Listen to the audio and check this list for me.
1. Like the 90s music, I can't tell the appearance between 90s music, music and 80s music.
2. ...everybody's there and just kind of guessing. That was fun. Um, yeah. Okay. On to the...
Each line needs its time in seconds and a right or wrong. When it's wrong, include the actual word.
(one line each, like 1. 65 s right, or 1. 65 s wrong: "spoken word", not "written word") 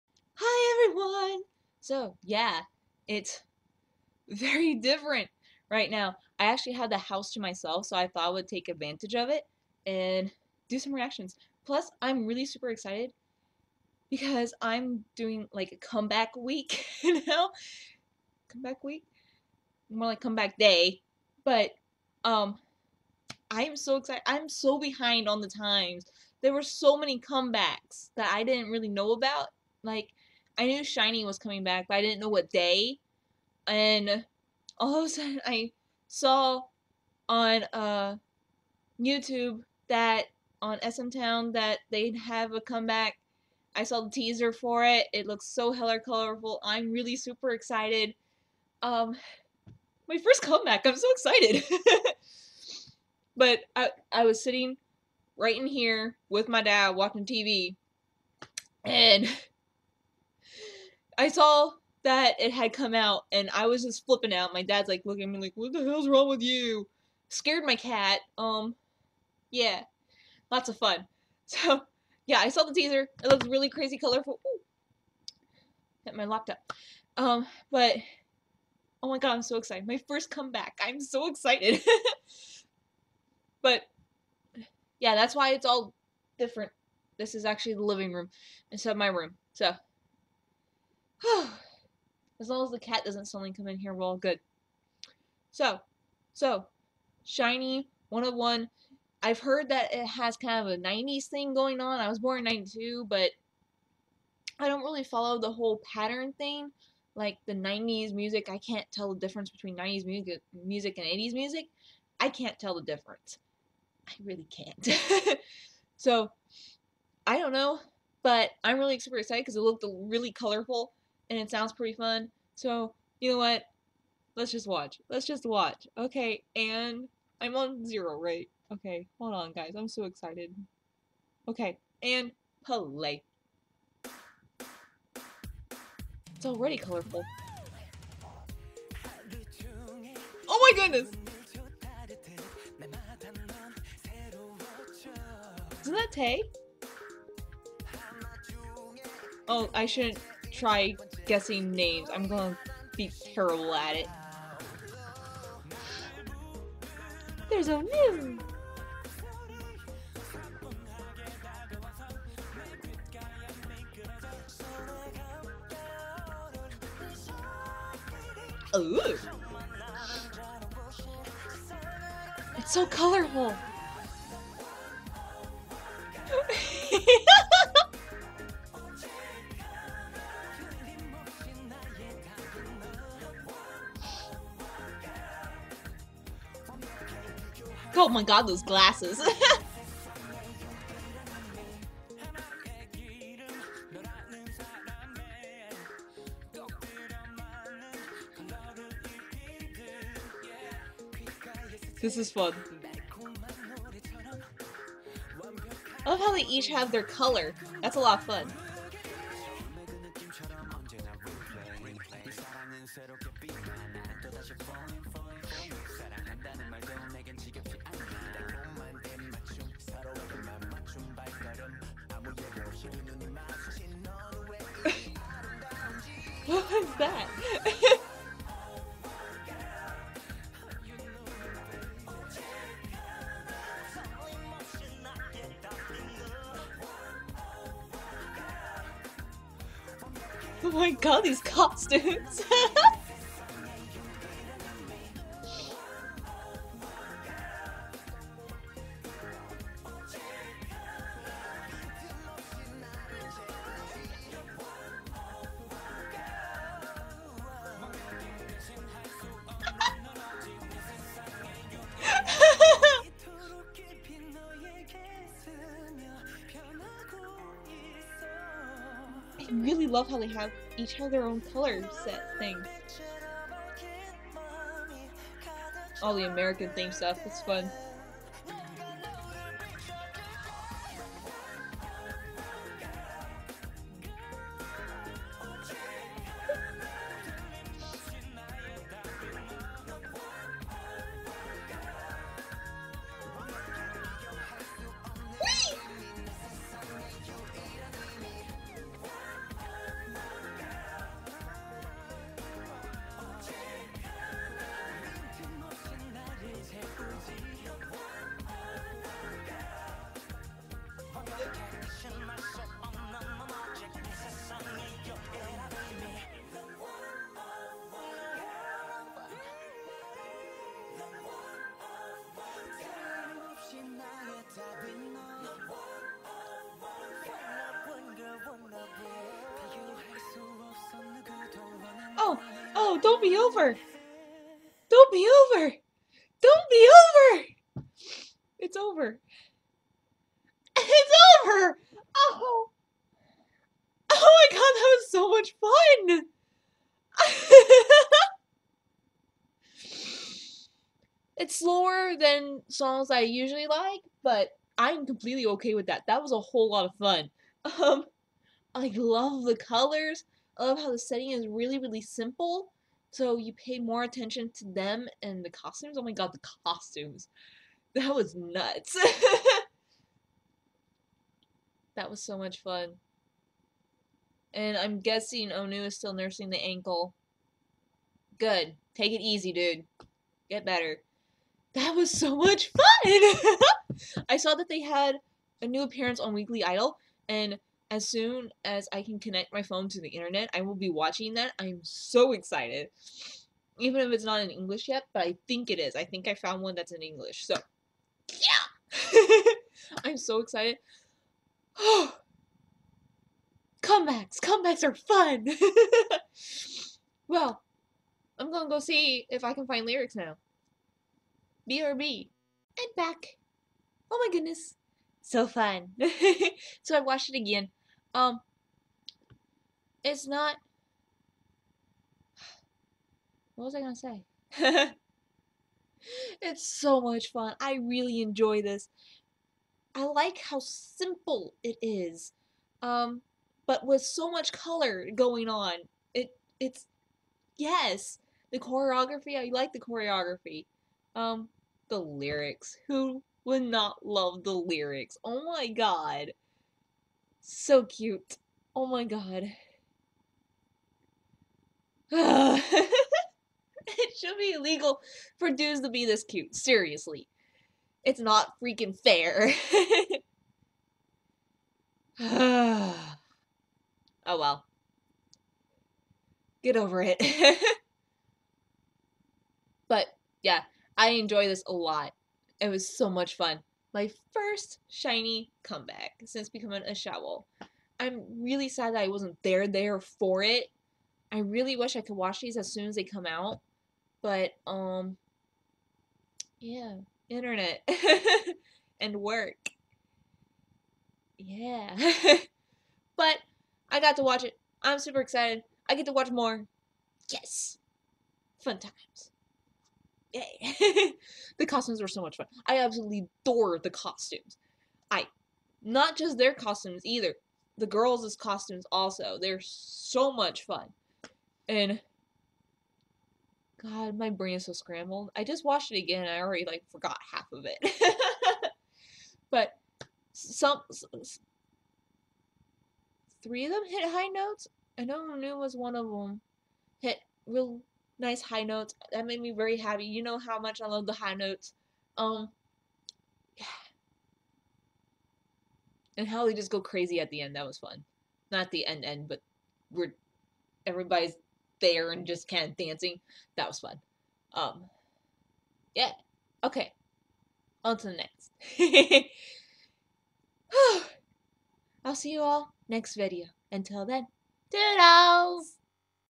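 1. 107 s wrong: "difference", not "appearance"
2. 540 s wrong: "dancing", not "guessing".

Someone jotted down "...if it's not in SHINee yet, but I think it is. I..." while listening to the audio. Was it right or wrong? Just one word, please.
wrong.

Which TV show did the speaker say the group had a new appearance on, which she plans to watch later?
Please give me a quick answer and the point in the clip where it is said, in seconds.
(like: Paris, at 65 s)
Weekly Idol, at 386 s.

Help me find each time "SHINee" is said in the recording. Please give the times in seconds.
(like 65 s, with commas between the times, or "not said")
30 s, 97 s, 474 s.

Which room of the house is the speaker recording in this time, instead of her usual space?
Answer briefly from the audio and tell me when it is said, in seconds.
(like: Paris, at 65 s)
The living room, at 87 s.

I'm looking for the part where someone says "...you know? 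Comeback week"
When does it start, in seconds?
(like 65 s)
17 s.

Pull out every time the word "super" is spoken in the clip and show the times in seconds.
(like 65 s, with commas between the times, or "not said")
12 s, 47 s, 118 s, 494 s.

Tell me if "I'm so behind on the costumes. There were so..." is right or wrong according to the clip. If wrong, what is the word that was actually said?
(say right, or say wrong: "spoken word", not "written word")
wrong: "times", not "costumes".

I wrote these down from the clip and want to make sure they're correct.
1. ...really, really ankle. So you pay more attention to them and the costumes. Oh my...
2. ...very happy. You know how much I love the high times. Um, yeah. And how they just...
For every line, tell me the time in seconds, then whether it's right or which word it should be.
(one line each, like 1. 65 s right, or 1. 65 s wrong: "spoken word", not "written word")
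1. 361 s wrong: "simple", not "ankle"
2. 529 s wrong: "notes", not "times".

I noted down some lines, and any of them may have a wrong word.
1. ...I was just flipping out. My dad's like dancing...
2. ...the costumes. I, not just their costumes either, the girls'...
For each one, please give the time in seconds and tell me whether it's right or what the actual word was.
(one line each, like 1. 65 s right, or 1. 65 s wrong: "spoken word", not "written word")
1. 63 s wrong: "looking", not "dancing"
2. 503 s right.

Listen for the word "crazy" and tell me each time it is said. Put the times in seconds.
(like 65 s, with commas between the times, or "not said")
73 s, 536 s.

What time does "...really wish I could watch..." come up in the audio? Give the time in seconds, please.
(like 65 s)
481 s.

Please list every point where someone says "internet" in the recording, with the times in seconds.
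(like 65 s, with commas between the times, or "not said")
390 s, 487 s.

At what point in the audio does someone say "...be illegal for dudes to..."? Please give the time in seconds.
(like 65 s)
454 s.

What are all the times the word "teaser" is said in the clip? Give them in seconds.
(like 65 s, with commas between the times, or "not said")
44 s, 72 s.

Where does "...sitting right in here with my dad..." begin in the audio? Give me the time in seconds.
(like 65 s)
54 s.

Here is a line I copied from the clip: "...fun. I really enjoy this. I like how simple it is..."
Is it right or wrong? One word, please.
right.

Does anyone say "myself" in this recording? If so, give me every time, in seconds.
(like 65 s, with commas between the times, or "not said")
7 s.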